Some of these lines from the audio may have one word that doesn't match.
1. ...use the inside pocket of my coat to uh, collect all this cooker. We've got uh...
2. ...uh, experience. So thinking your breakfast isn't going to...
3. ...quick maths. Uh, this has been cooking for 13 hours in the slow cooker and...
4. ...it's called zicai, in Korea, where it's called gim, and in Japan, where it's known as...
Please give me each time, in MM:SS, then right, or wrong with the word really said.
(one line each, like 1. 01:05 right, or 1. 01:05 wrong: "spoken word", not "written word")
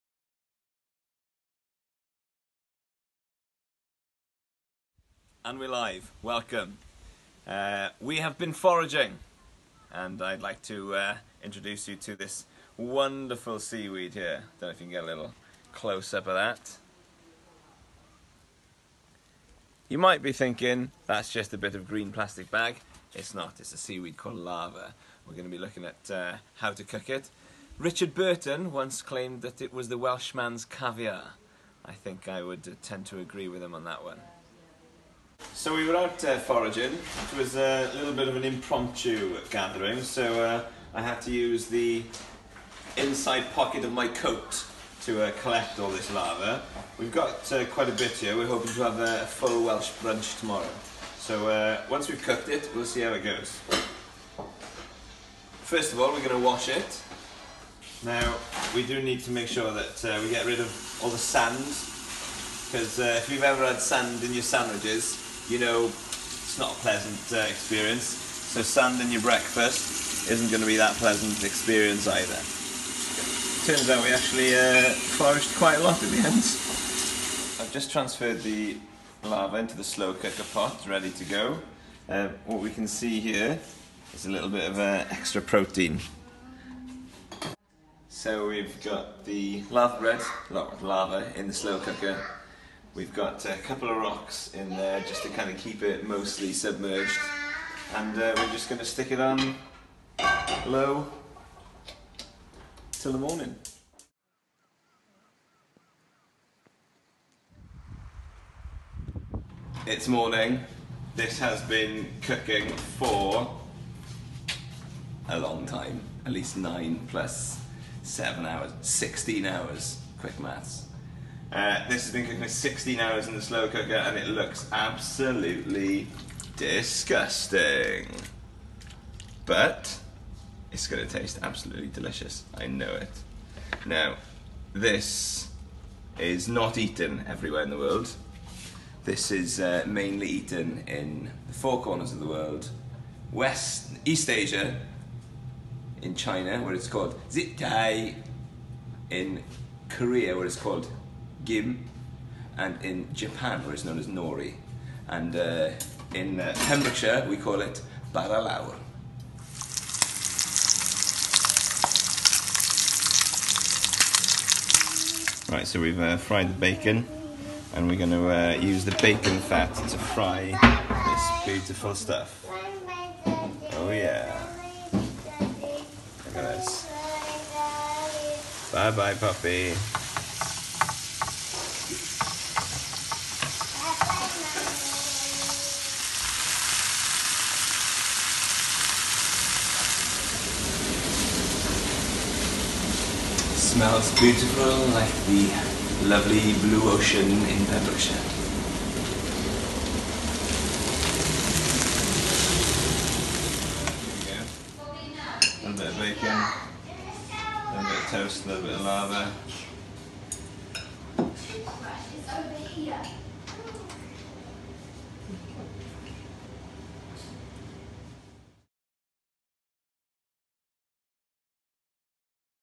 1. 00:41 wrong: "laver", not "cooker"
2. 01:07 wrong: "sanding", not "thinking"
3. 02:00 wrong: "16", not "13"
4. 02:26 right.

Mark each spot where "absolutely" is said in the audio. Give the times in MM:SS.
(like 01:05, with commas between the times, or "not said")
02:04, 02:11.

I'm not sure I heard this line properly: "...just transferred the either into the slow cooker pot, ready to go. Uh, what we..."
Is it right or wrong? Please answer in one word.
wrong.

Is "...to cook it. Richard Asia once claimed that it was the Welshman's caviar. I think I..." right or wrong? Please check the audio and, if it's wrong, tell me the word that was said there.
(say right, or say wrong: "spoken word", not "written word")
wrong: "Burton", not "Asia".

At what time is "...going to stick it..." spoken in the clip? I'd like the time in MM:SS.
01:38.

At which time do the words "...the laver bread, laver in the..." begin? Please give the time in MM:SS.
01:29.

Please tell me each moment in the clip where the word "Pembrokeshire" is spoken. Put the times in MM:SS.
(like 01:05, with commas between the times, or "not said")
02:36, 03:17.